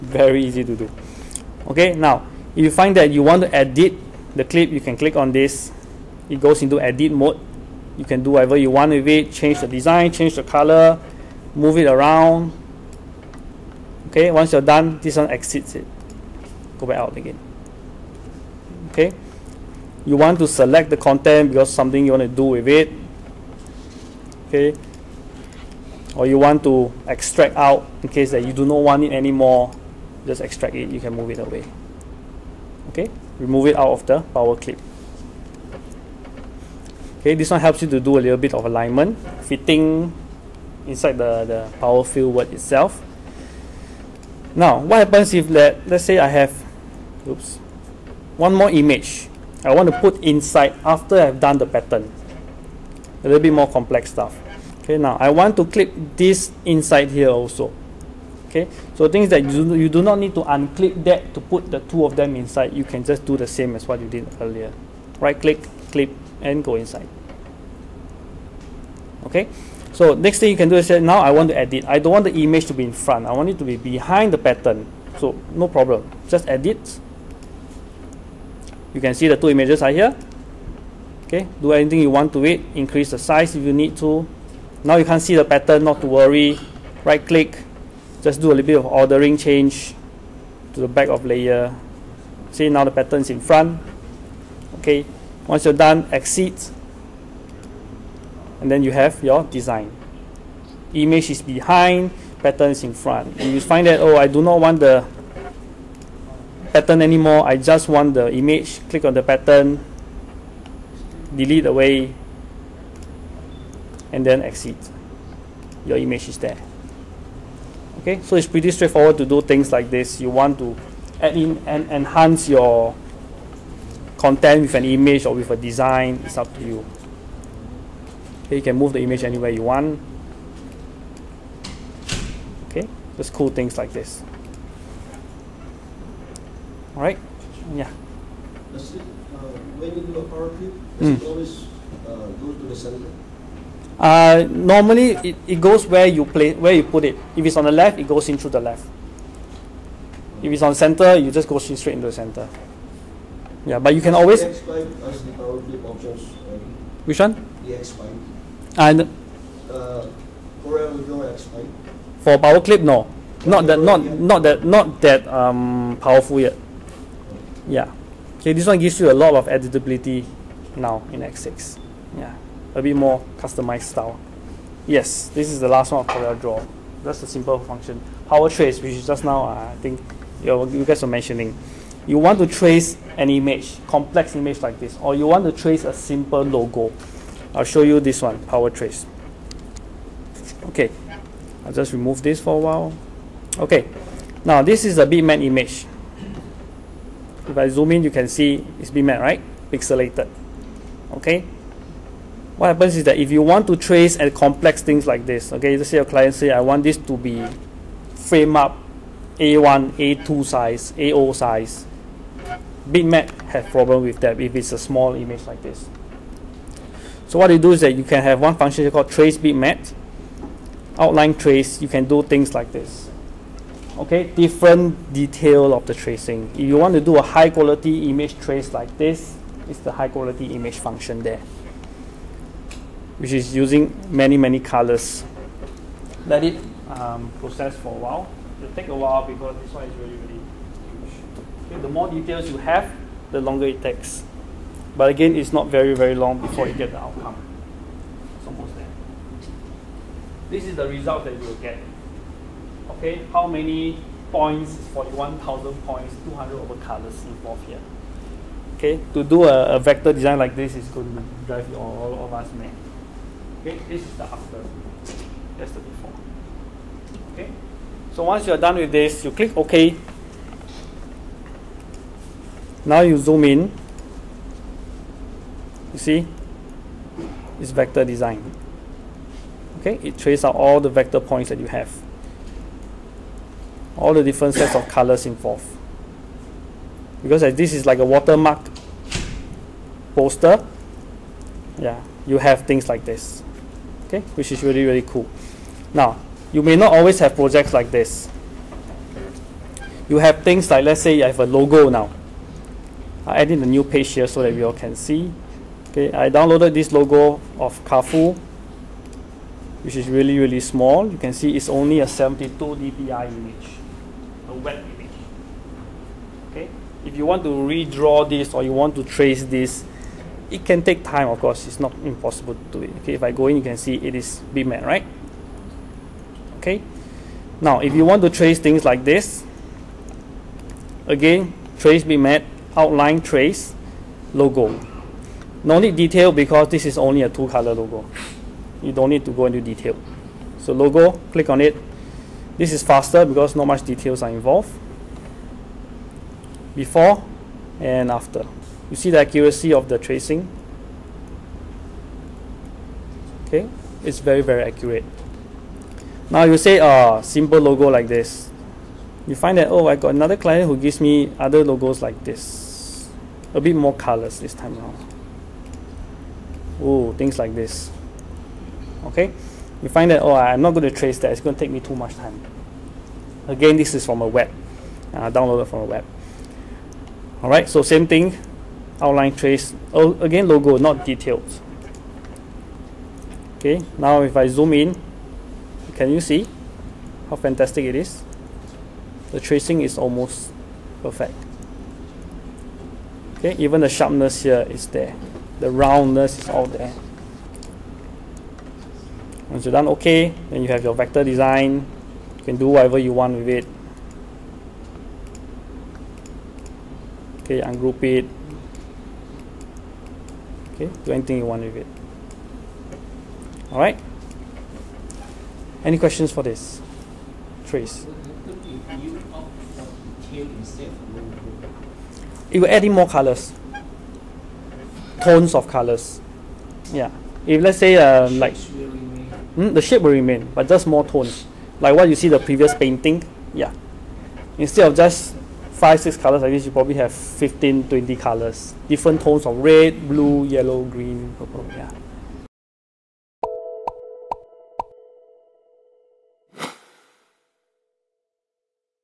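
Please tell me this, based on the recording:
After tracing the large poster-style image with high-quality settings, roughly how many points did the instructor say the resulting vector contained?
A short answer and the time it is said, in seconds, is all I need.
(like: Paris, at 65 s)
41,000, at 254 s.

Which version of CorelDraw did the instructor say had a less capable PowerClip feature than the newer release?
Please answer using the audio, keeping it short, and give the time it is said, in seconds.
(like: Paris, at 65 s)
X5, at 157 s.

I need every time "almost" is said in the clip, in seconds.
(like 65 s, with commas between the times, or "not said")
248 s, 389 s.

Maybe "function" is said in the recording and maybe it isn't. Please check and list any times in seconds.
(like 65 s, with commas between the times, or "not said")
177 s, 218 s, 230 s.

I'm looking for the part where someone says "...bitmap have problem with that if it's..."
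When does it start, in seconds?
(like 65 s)
212 s.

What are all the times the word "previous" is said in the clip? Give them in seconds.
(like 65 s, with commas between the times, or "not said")
432 s.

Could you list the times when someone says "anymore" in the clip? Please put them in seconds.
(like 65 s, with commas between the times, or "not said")
29 s, 107 s.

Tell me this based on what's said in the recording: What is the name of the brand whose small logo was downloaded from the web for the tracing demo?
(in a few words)
Kafu.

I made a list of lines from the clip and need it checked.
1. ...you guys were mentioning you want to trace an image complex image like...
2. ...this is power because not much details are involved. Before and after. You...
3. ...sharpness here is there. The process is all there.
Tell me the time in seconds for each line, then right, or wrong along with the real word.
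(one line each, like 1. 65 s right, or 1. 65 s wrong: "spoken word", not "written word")
1. 180 s right
2. 342 s wrong: "faster", not "power"
3. 393 s wrong: "roundness", not "process".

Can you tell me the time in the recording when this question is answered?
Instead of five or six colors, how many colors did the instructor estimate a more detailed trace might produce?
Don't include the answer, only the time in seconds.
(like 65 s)
437 s.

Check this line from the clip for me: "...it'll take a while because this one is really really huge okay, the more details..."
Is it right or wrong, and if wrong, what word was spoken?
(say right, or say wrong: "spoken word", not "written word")
right.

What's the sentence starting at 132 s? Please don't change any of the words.
Okay, just cool things like this.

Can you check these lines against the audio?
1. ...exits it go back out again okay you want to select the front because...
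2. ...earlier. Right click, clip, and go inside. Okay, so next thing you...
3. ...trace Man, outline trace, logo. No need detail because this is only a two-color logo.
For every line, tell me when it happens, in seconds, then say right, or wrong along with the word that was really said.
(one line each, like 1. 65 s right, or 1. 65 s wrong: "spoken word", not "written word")
1. 15 s wrong: "content", not "front"
2. 64 s right
3. 331 s right.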